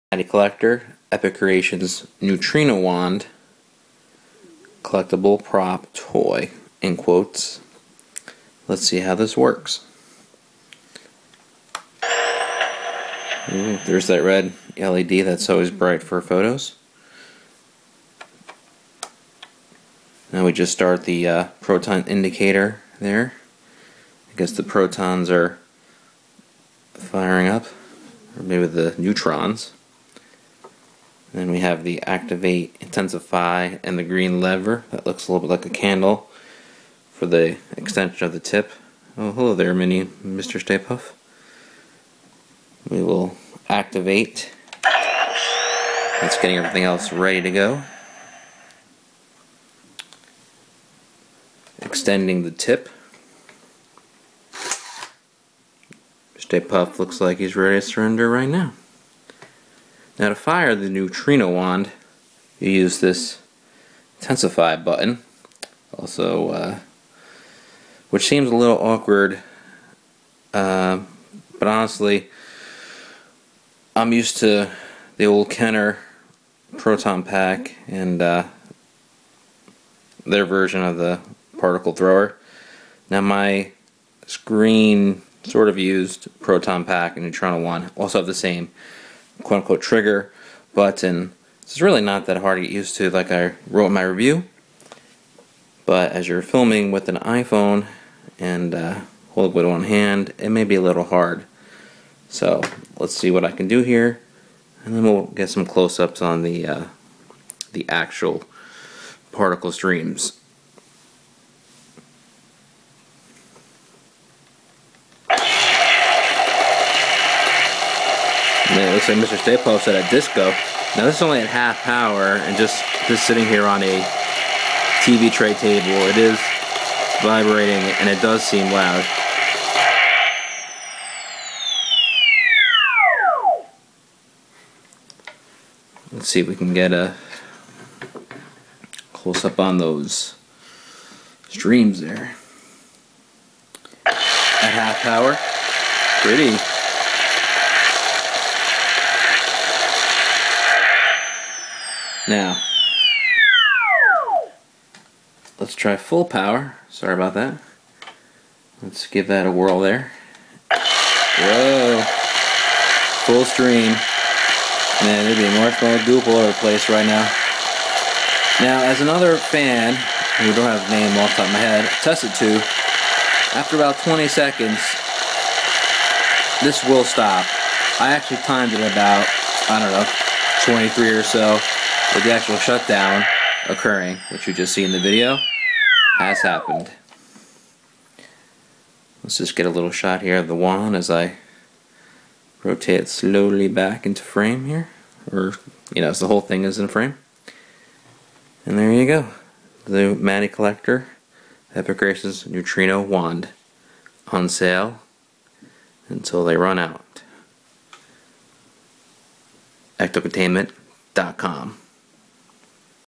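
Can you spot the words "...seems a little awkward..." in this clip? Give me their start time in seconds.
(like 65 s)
68 s.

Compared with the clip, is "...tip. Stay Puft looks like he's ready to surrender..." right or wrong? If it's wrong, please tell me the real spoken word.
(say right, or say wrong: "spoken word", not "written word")
right.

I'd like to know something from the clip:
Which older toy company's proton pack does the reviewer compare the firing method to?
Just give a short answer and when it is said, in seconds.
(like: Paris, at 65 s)
Kenner, at 75 s.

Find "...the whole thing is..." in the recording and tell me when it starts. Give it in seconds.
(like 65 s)
196 s.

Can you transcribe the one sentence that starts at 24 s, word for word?
I guess the protons are firing up, or maybe the neutrons.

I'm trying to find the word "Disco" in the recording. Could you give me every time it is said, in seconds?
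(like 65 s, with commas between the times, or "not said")
120 s.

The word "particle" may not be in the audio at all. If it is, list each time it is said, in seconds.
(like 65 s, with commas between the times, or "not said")
81 s, 109 s.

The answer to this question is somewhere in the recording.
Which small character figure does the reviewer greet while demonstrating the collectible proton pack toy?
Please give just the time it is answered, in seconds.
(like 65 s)
39 s.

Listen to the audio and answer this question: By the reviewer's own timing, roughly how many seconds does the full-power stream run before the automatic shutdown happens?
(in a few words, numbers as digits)
23.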